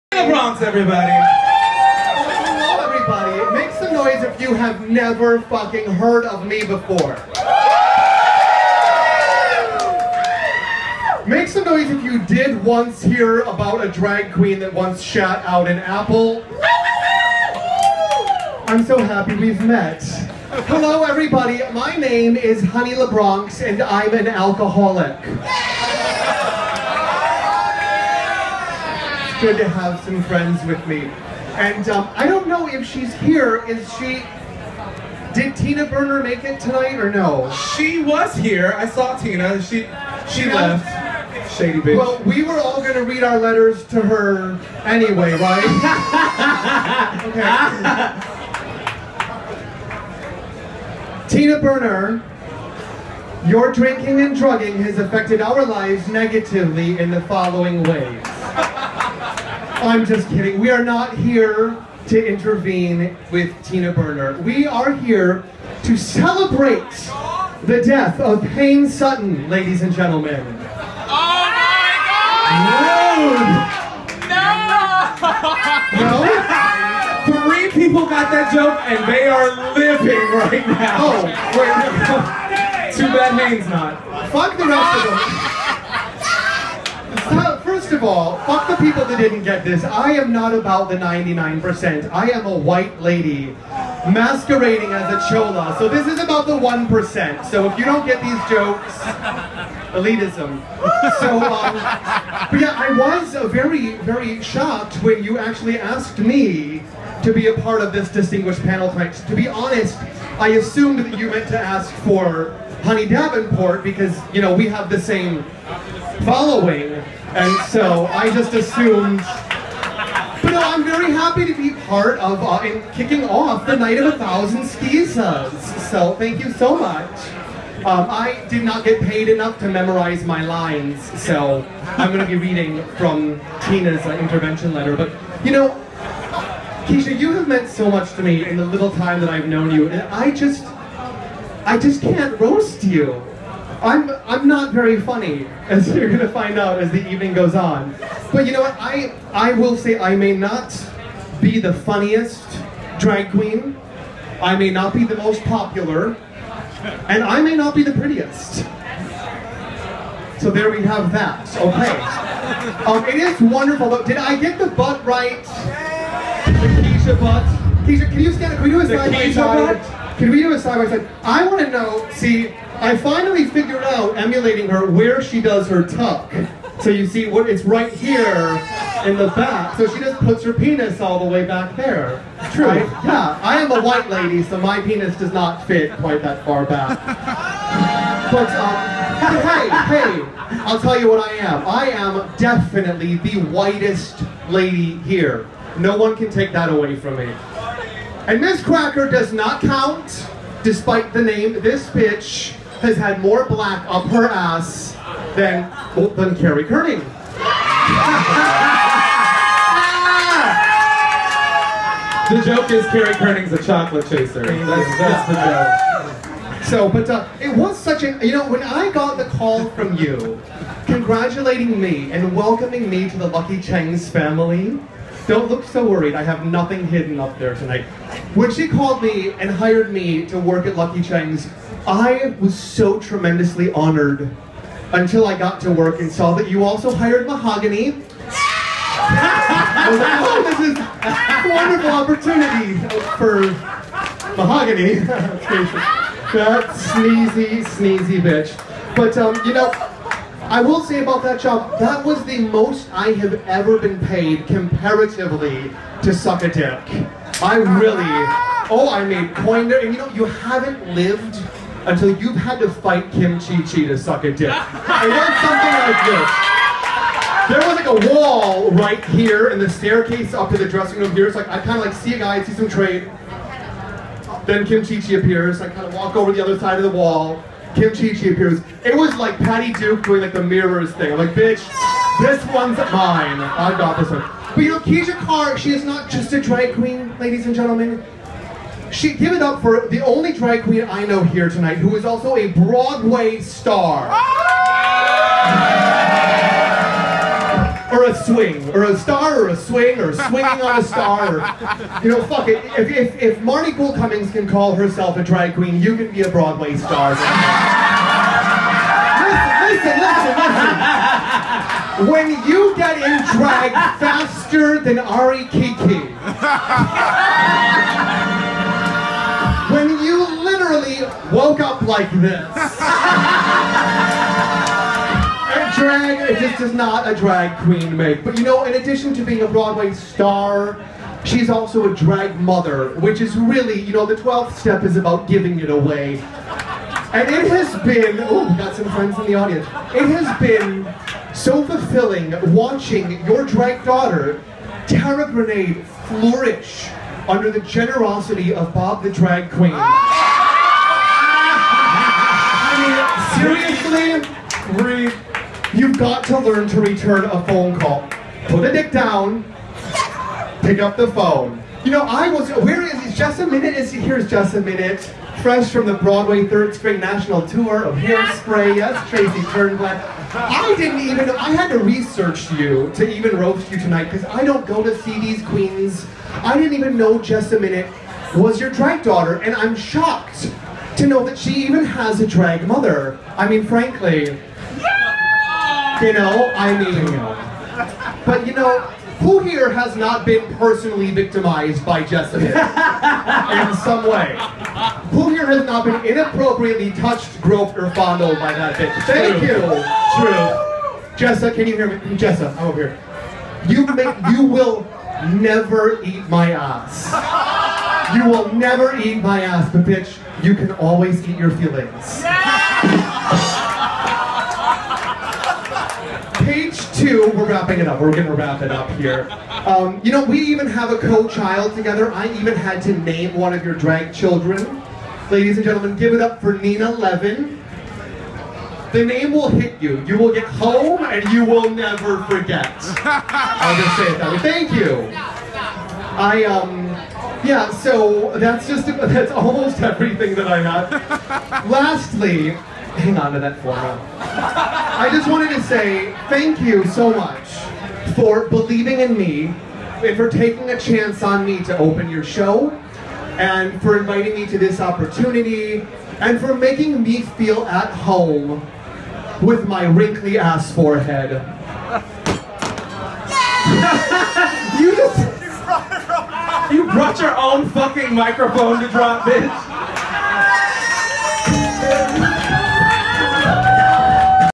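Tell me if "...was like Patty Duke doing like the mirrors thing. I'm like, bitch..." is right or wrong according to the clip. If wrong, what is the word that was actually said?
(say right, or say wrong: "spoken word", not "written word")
right.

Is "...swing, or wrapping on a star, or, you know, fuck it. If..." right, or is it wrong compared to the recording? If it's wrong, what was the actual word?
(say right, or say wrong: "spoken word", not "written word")
wrong: "swinging", not "wrapping".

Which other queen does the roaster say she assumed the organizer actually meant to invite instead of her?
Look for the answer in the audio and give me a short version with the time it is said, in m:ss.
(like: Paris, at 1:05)
Honey Davenport, at 1:52.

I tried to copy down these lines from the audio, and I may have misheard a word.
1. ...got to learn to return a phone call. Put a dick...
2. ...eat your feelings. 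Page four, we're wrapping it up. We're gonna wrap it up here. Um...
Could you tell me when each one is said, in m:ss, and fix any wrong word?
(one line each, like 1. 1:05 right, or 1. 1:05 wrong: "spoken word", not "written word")
1. 5:55 right
2. 6:51 wrong: "two", not "four".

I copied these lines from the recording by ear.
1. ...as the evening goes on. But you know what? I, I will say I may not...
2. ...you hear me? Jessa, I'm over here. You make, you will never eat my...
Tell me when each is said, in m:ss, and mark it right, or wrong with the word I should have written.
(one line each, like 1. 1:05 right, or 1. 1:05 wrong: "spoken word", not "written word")
1. 2:26 right
2. 6:41 right.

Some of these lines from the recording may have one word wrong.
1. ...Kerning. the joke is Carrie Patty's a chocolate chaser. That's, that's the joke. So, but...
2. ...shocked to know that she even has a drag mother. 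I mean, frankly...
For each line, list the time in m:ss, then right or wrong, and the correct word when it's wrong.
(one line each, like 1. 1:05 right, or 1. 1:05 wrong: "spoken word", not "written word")
1. 3:26 wrong: "Kerning", not "Patty"
2. 6:19 right.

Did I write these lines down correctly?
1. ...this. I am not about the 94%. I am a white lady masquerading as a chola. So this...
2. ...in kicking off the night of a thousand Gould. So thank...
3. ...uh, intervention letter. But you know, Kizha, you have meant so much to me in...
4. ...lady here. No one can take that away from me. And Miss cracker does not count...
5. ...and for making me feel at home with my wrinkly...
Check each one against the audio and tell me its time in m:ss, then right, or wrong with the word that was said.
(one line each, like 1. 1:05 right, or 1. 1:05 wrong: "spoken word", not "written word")
1. 1:29 wrong: "99", not "94"
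2. 2:02 wrong: "Kizhas", not "Gould"
3. 2:14 right
4. 3:14 right
5. 7:36 right.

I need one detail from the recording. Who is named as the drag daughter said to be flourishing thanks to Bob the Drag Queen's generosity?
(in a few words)
Tara Grenade.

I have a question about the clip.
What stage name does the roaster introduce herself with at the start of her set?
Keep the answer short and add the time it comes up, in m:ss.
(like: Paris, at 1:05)
Honey LaBronx, at 0:22.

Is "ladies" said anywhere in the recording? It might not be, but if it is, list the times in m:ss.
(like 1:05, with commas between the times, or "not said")
1:09, 4:47, 7:05.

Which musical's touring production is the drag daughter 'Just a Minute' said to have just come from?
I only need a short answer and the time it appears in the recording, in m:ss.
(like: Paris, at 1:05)
Hairspray, at 6:07.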